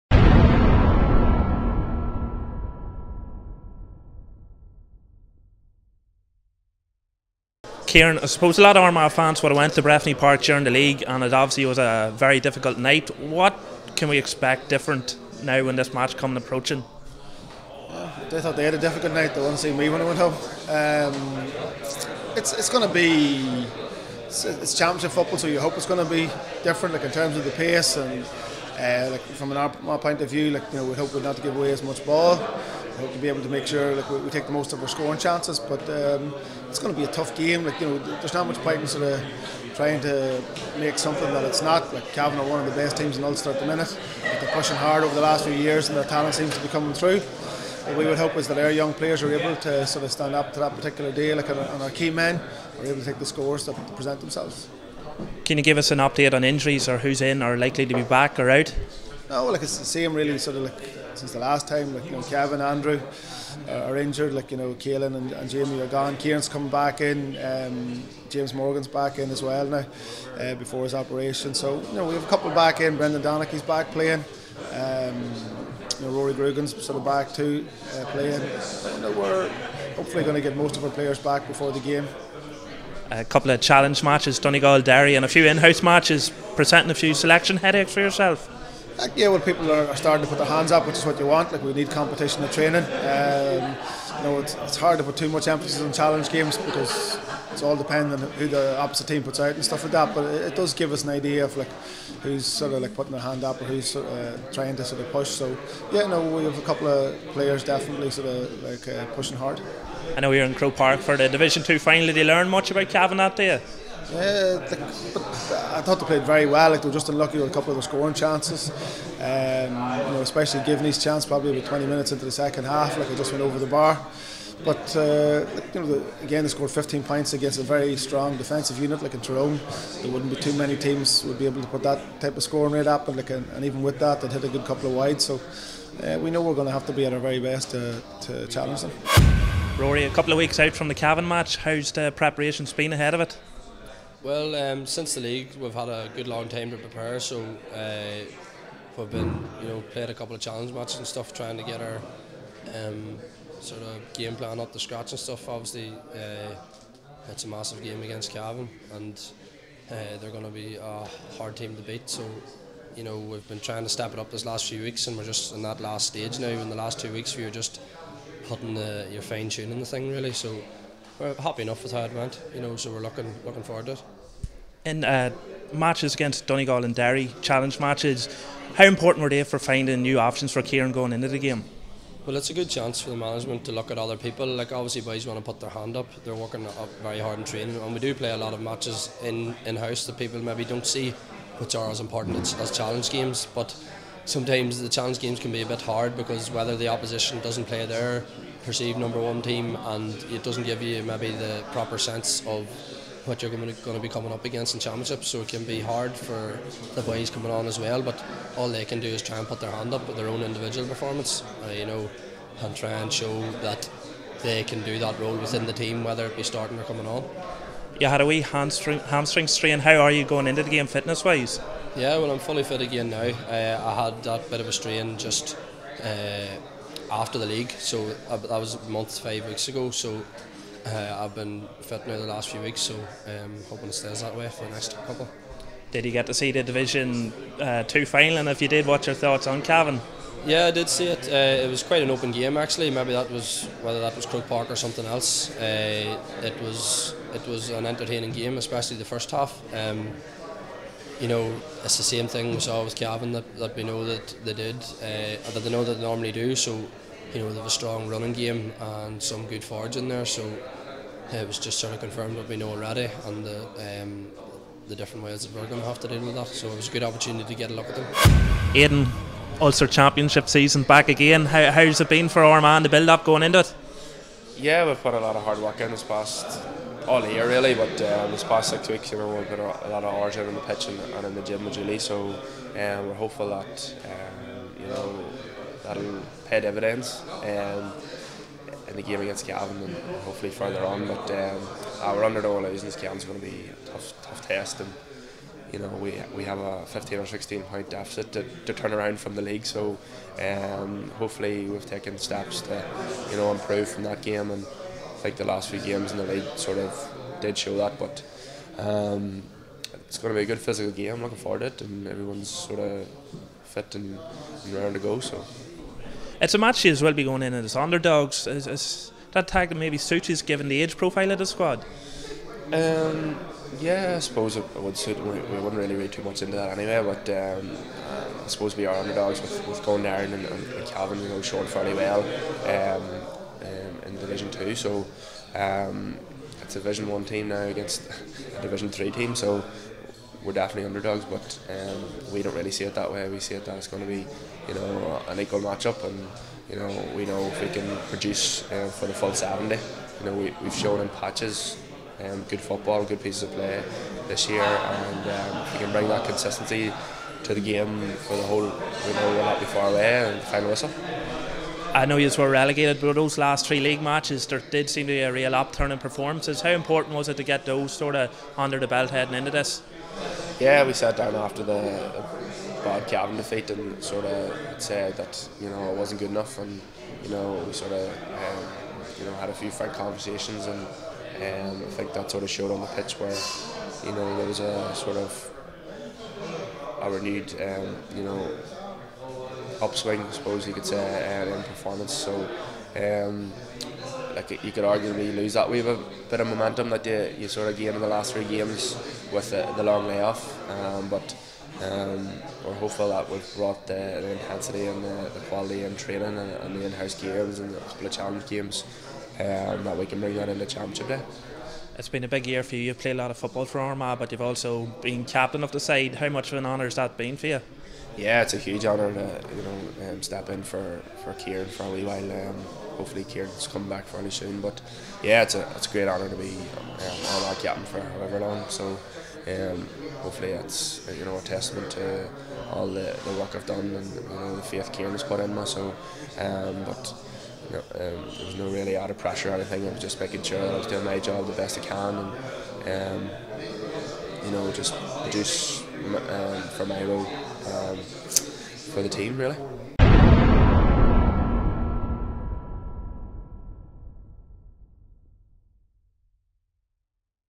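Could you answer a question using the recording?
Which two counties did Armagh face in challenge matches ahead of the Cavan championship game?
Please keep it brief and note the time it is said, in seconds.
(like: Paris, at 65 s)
Donegal and Derry, at 84 s.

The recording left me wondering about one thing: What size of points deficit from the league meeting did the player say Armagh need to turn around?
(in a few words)
15 or 16 points.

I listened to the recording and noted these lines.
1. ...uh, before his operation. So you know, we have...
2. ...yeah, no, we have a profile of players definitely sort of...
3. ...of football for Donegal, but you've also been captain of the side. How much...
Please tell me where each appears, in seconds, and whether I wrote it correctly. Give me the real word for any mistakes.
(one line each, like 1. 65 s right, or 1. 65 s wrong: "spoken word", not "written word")
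1. 70 s right
2. 105 s wrong: "couple", not "profile"
3. 413 s wrong: "Armagh", not "Donegal".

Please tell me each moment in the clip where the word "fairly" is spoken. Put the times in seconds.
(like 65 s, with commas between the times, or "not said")
331 s, 424 s.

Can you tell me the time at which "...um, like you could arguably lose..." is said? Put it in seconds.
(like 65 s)
392 s.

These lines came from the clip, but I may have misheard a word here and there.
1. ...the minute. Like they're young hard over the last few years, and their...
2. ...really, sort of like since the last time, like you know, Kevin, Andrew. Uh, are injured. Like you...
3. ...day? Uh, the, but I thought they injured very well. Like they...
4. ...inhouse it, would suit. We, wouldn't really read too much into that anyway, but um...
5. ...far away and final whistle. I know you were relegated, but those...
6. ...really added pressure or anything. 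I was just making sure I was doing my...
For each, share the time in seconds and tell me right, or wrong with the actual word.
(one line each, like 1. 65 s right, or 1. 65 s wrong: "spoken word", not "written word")
1. 43 s wrong: "pushing", not "young"
2. 60 s right
3. 113 s wrong: "played", not "injured"
4. 324 s wrong: "suppose", not "inhouse"
5. 359 s right
6. 438 s right.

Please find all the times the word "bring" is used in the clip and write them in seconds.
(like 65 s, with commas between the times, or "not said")
355 s, 410 s.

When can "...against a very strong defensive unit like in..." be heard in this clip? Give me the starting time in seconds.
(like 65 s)
127 s.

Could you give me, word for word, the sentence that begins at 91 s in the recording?
Like we need competition and training.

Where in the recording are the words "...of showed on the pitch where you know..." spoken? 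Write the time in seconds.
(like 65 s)
382 s.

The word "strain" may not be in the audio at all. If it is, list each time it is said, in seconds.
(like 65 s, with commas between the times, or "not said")
219 s, 224 s.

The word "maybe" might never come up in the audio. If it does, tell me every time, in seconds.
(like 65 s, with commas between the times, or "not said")
190 s, 201 s, 242 s, 319 s.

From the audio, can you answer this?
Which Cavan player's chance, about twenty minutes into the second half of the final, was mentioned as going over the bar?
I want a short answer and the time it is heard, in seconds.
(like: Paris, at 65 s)
Givney, at 120 s.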